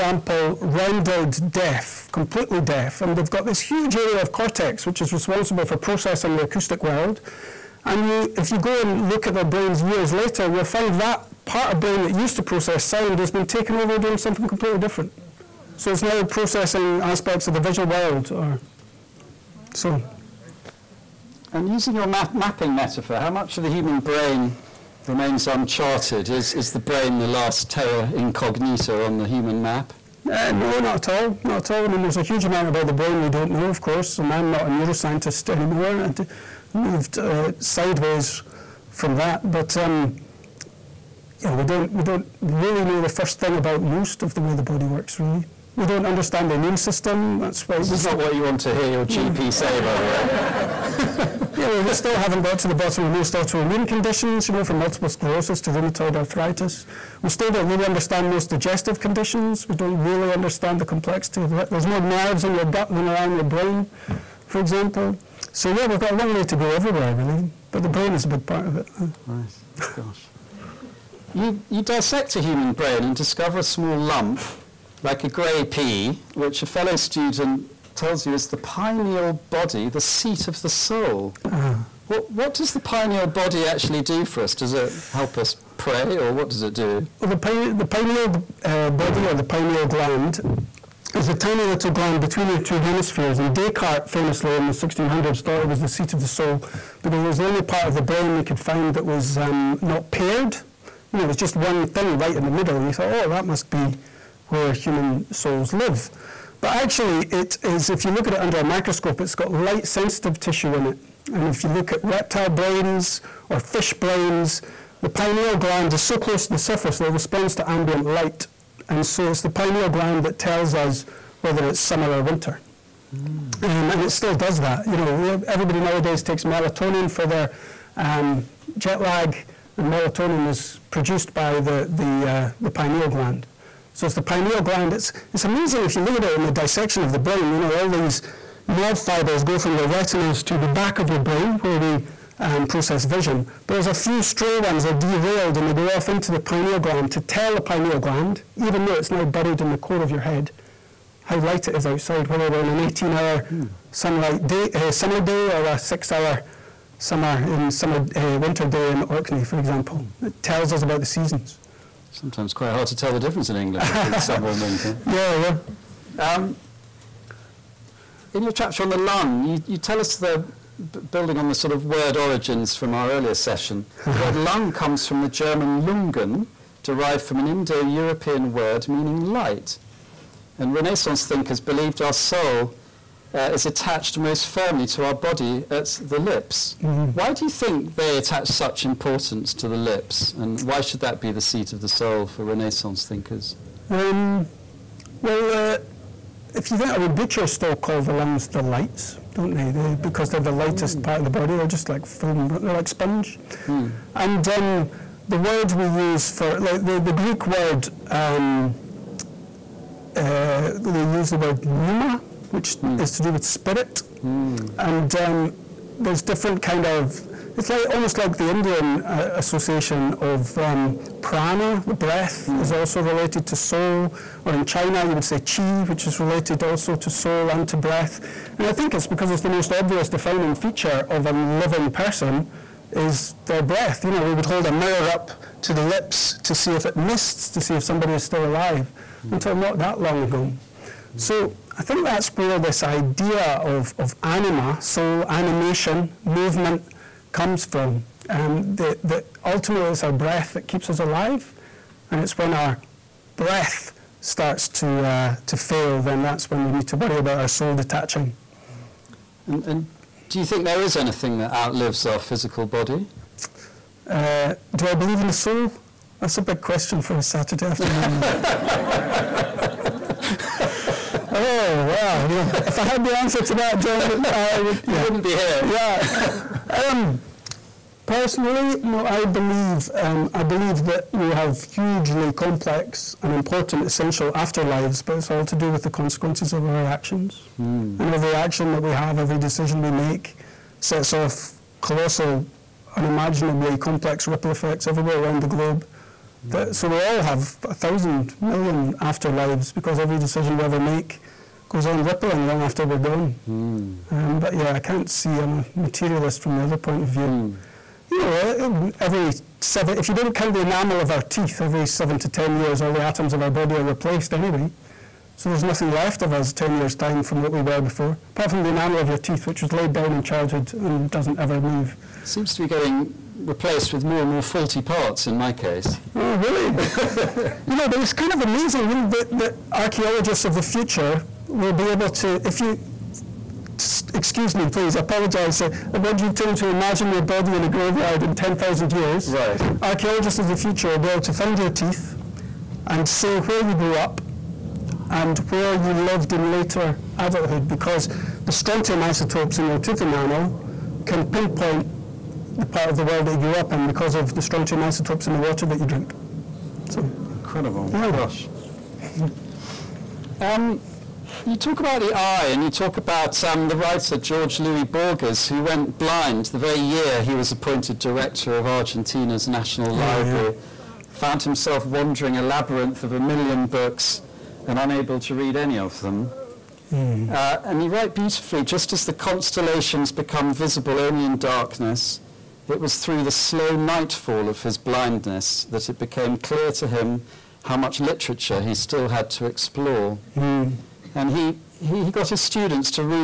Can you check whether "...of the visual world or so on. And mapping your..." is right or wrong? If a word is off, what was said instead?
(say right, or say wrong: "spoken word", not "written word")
wrong: "using", not "mapping".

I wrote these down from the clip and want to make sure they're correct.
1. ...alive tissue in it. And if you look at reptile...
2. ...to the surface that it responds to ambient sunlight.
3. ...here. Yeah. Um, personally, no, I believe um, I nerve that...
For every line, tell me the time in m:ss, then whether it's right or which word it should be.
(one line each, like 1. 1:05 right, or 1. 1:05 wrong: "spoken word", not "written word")
1. 1:49 wrong: "sensitive", not "alive"
2. 1:56 wrong: "light", not "sunlight"
3. 4:35 wrong: "believe", not "nerve".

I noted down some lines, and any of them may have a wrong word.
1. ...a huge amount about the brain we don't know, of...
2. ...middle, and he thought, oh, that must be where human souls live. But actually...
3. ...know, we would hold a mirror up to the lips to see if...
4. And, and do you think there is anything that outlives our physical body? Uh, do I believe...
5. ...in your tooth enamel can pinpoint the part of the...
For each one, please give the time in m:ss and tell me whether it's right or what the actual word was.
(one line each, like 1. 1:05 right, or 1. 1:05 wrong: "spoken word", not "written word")
1. 0:32 right
2. 1:42 right
3. 3:54 right
4. 4:19 right
5. 5:49 right.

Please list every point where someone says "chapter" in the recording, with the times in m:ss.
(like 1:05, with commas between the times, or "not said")
2:48.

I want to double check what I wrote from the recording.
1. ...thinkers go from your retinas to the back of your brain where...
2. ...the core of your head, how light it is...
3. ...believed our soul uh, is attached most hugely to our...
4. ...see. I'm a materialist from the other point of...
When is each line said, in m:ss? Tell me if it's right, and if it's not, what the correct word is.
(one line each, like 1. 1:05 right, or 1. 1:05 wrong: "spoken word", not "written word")
1. 2:18 wrong: "fibers", not "thinkers"
2. 2:29 right
3. 3:01 wrong: "firmly", not "hugely"
4. 5:05 right.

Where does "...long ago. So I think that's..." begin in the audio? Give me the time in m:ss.
4:00.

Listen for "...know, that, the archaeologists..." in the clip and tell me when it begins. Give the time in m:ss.
5:28.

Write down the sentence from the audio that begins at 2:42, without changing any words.
Sometimes quite hard to tell the difference in England between summer and winter.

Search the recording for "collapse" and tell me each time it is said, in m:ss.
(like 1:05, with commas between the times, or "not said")
not said.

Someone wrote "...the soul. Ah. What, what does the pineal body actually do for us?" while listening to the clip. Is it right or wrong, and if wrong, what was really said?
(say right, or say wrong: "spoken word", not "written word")
right.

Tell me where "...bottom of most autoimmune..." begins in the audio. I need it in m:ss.
0:52.